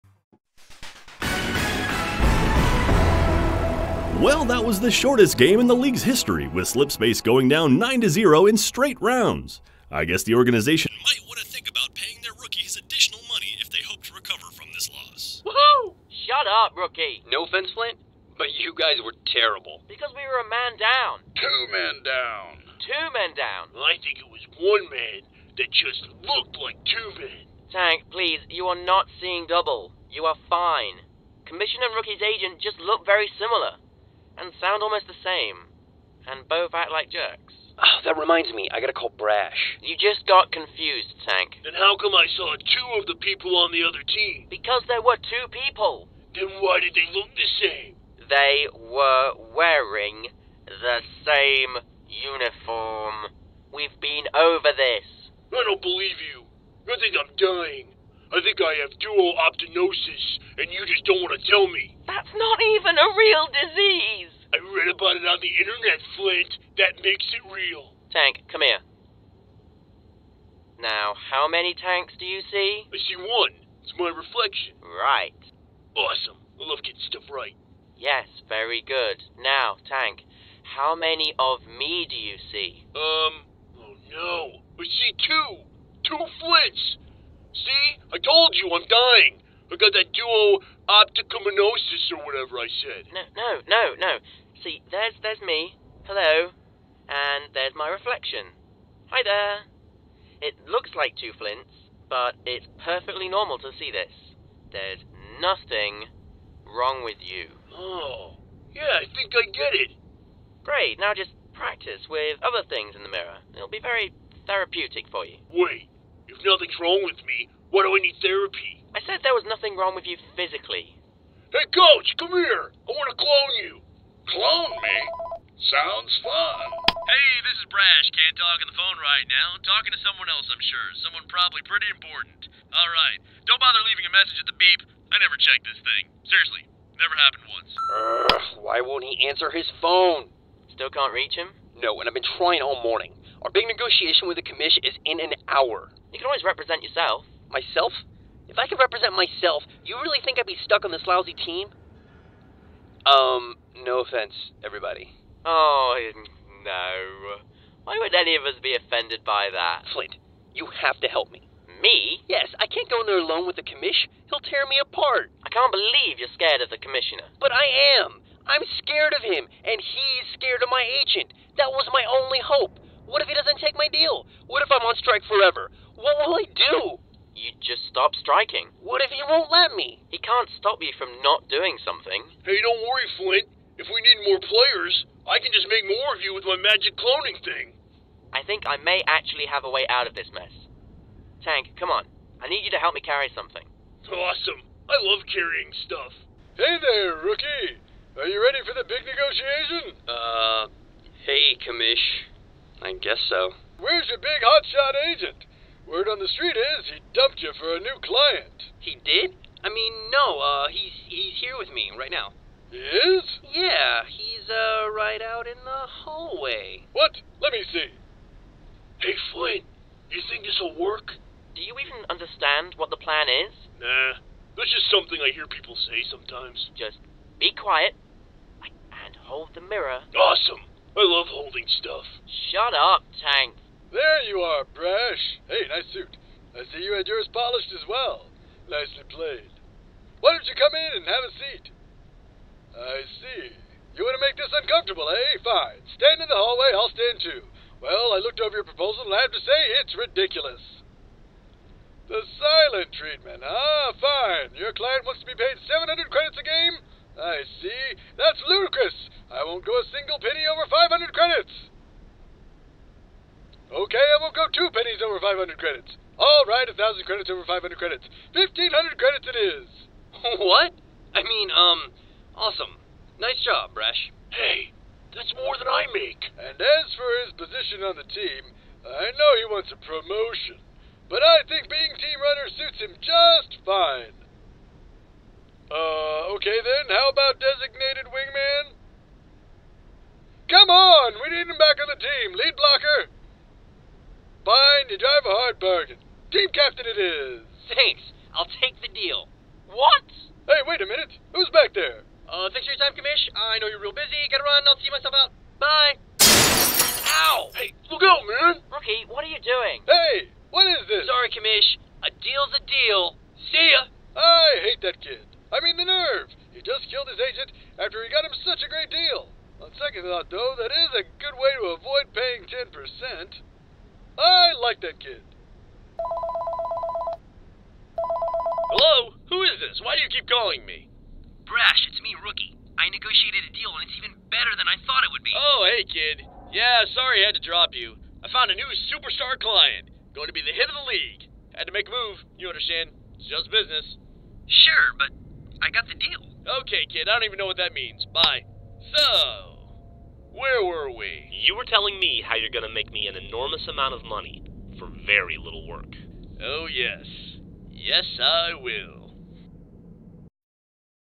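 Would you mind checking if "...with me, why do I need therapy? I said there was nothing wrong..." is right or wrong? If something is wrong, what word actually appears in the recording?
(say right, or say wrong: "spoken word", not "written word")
right.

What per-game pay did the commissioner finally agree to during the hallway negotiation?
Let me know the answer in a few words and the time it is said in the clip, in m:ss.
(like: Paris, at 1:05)
1500 credits, at 4:28.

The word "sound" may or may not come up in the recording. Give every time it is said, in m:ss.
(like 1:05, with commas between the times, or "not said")
0:34, 2:05.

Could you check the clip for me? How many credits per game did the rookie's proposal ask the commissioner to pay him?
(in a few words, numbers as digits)
700.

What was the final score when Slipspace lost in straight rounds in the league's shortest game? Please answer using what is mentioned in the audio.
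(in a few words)
9-0.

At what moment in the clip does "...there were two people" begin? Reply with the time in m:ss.
0:44.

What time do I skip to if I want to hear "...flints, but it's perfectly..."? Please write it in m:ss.
1:41.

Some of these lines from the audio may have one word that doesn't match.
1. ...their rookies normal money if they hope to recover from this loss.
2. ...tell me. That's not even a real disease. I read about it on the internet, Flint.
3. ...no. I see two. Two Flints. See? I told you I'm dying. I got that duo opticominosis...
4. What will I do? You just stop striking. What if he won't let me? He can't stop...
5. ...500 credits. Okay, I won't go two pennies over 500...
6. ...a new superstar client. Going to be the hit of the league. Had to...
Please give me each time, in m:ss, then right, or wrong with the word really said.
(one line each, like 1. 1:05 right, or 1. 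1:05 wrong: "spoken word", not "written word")
1. 0:12 wrong: "additional", not "normal"
2. 1:01 right
3. 1:24 right
4. 2:55 right
5. 4:20 right
6. 5:38 right.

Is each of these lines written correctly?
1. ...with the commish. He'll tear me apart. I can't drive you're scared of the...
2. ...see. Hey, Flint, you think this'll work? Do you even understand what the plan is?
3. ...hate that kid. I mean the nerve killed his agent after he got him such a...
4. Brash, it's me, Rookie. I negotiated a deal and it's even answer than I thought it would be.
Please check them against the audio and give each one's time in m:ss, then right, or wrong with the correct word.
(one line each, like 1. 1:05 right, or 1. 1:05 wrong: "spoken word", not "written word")
1. 2:43 wrong: "believe", not "drive"
2. 3:37 right
3. 5:14 right
4. 5:31 wrong: "better", not "answer".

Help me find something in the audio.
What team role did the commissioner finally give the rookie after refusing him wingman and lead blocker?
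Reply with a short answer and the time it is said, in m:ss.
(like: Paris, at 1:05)
Team captain, at 4:56.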